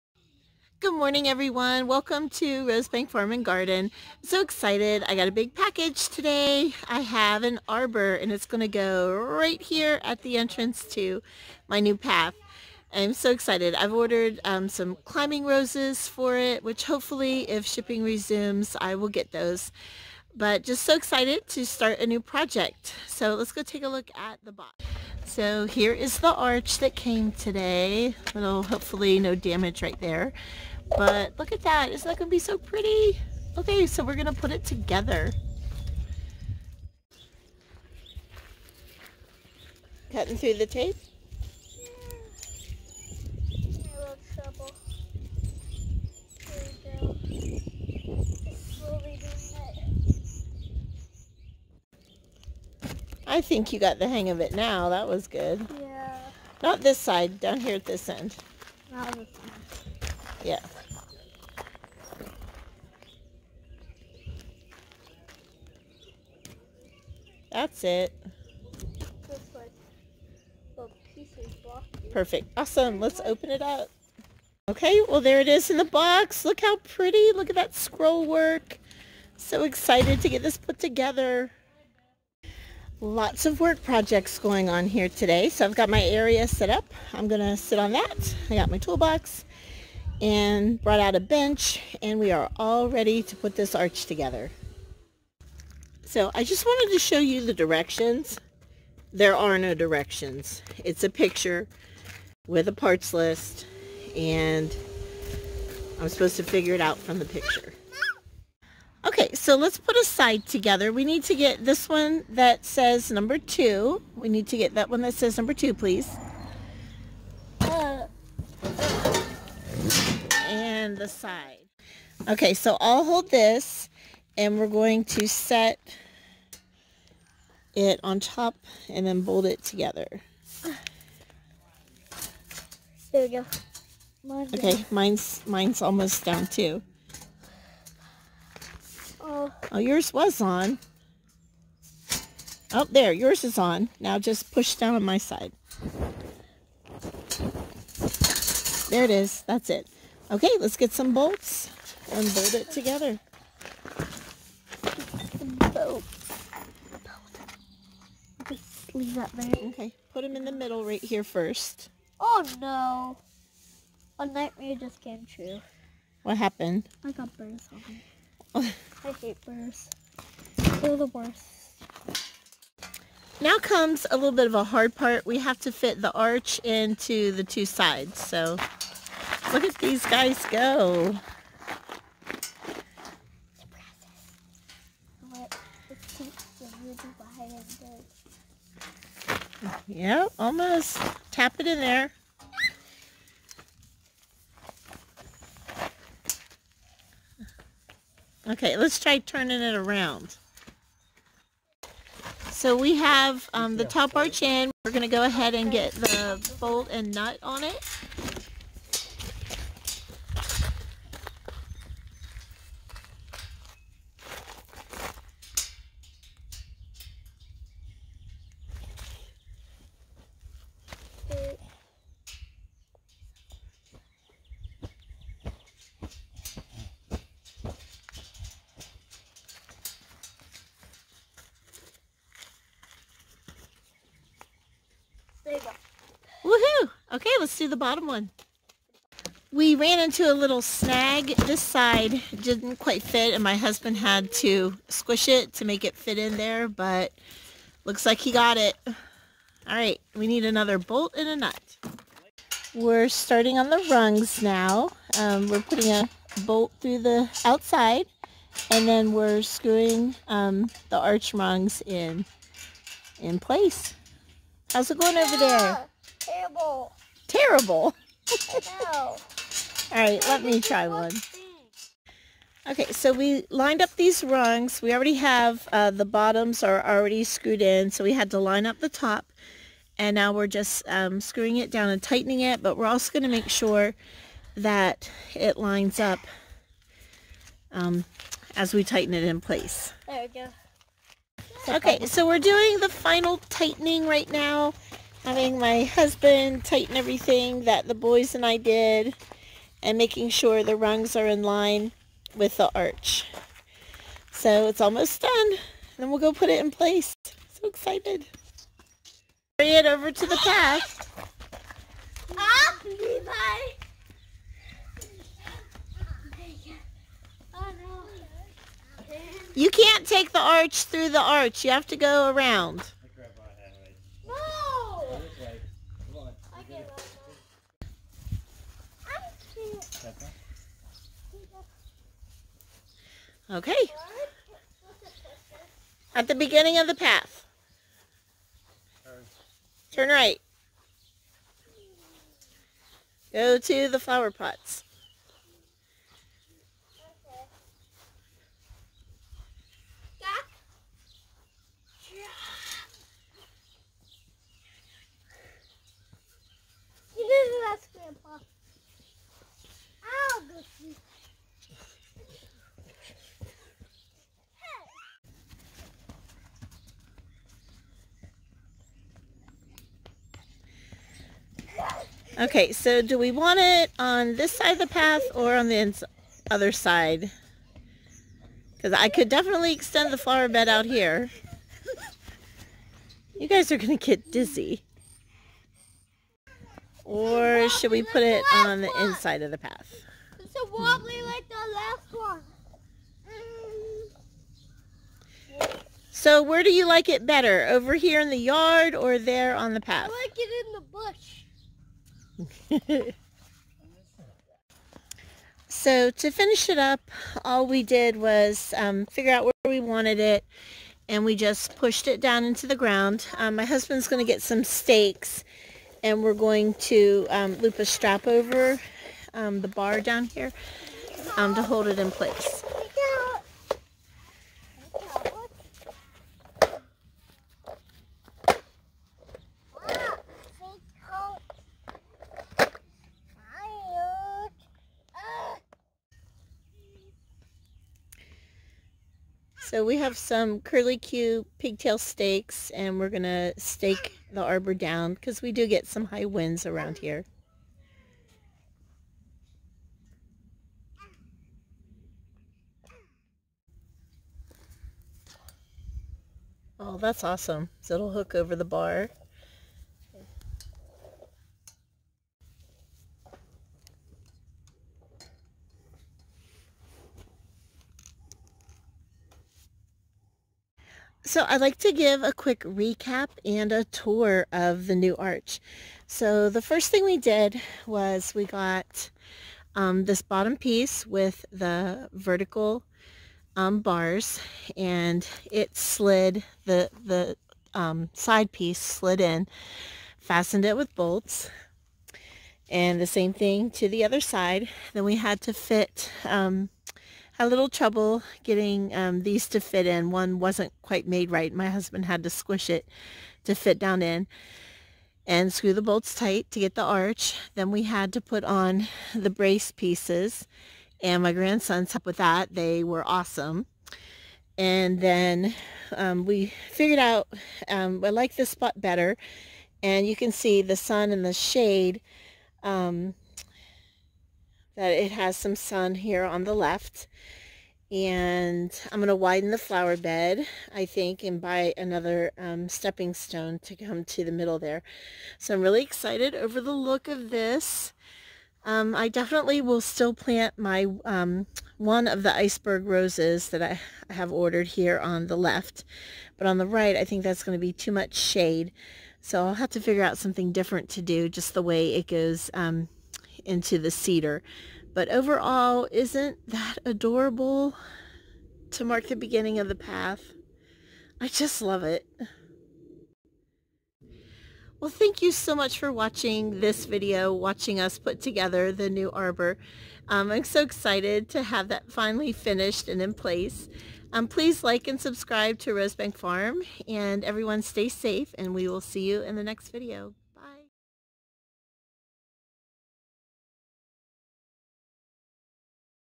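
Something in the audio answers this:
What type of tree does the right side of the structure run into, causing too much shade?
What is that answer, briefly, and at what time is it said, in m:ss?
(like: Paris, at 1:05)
Cedar, at 9:13.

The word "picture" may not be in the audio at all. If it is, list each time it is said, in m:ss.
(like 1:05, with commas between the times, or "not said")
1:41, 1:47.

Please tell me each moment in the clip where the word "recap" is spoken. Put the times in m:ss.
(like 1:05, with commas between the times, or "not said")
7:52.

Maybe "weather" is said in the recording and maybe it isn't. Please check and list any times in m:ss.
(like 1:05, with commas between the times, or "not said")
not said.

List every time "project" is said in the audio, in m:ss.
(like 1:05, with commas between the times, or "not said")
0:22, 1:23.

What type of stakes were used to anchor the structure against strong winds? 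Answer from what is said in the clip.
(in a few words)
Curly Q pigtail stakes.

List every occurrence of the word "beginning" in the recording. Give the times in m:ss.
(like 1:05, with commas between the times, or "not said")
5:36, 9:19.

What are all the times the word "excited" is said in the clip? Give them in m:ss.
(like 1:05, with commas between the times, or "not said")
0:04, 0:13, 0:20, 1:19, 5:07, 8:55, 9:30.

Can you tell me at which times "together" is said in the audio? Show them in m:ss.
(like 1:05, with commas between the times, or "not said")
0:34, 1:20, 1:34, 1:50, 2:09, 2:32, 9:28.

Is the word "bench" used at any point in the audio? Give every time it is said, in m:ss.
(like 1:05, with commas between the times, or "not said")
1:31.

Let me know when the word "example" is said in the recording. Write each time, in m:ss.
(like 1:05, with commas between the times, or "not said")
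not said.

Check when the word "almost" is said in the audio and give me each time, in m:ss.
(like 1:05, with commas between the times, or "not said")
2:15, 3:10, 5:04.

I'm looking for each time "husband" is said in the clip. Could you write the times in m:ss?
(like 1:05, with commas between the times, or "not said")
4:03, 4:55, 6:53, 8:21.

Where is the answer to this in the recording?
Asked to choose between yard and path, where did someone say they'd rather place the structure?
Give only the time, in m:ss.
6:40.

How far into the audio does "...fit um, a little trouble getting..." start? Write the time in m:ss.
8:15.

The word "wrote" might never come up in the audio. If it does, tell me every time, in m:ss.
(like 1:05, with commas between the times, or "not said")
not said.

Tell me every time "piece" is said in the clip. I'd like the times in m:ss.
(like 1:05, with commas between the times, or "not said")
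8:00, 8:08, 8:29.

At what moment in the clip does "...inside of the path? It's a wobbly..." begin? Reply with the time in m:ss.
6:29.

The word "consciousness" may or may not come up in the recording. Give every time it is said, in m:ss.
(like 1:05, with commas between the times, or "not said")
not said.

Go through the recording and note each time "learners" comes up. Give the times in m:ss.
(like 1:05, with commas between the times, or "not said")
not said.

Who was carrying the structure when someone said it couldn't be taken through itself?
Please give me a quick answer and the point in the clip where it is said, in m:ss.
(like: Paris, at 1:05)
Levi, at 5:12.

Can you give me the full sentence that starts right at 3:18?
Okay, let's try turning it around.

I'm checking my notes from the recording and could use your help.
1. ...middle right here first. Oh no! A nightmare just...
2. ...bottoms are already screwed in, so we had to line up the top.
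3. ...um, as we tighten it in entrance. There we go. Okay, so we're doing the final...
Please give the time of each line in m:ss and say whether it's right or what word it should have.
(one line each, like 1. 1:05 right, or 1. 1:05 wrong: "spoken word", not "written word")
1. 2:40 right
2. 4:36 right
3. 4:47 wrong: "place", not "entrance".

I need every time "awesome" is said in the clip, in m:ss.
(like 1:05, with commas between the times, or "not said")
1:12, 7:37, 8:33.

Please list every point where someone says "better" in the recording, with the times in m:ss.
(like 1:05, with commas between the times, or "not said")
6:37, 8:38.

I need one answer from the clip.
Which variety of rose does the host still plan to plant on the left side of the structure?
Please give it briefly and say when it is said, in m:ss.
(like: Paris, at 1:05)
Iceberg, at 9:02.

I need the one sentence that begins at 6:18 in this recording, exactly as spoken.
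Because I could definitely extend the flower bed out here.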